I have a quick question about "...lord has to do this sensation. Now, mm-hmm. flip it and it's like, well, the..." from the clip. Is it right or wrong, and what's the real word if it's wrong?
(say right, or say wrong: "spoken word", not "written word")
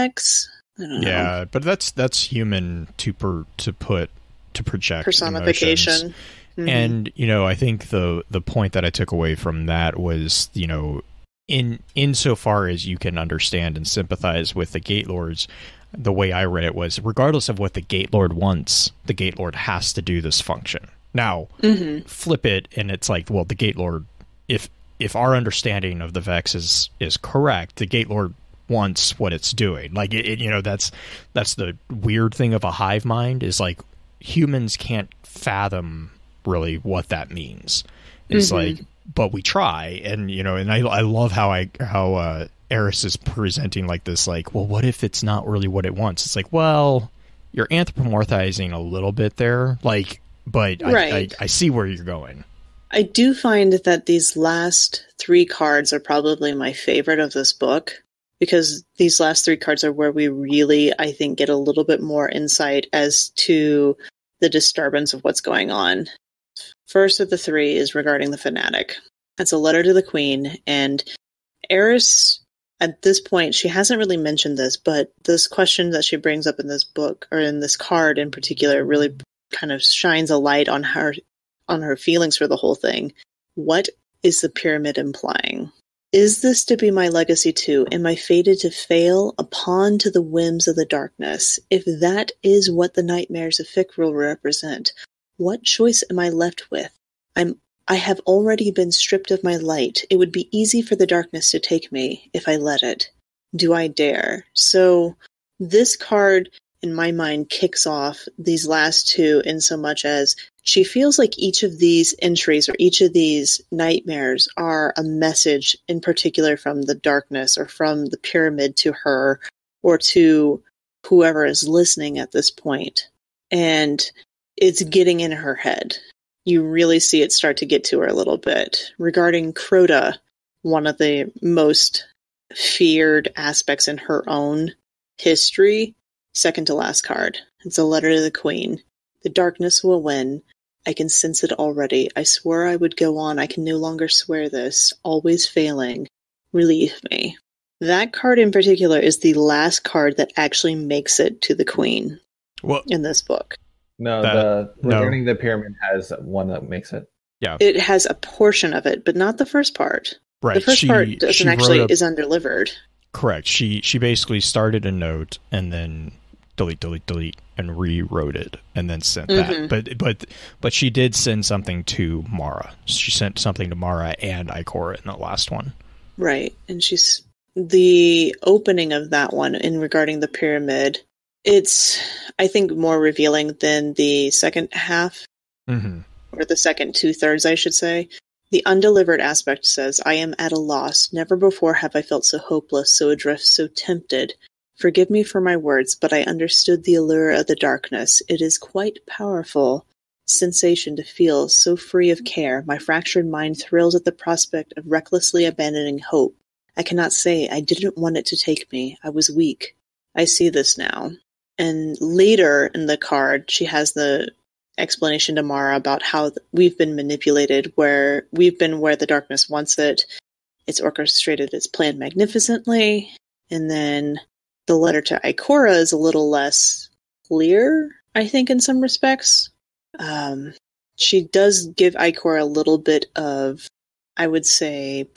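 wrong: "function", not "sensation".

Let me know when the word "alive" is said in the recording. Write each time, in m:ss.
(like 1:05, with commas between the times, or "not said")
not said.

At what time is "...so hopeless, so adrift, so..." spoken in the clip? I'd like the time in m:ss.
3:12.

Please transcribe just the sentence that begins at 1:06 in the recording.
First of the three is regarding the fanatic.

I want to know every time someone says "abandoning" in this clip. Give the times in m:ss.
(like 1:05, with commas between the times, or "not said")
3:25.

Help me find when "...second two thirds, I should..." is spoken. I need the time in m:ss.
3:06.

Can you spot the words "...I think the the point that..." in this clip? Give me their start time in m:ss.
0:07.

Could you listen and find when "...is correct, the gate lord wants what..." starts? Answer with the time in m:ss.
0:26.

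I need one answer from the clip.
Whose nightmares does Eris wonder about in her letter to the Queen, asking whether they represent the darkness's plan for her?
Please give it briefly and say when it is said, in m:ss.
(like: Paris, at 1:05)
Fikrul, at 1:33.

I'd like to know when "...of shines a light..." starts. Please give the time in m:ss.
1:19.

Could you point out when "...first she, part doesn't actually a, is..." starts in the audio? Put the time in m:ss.
2:40.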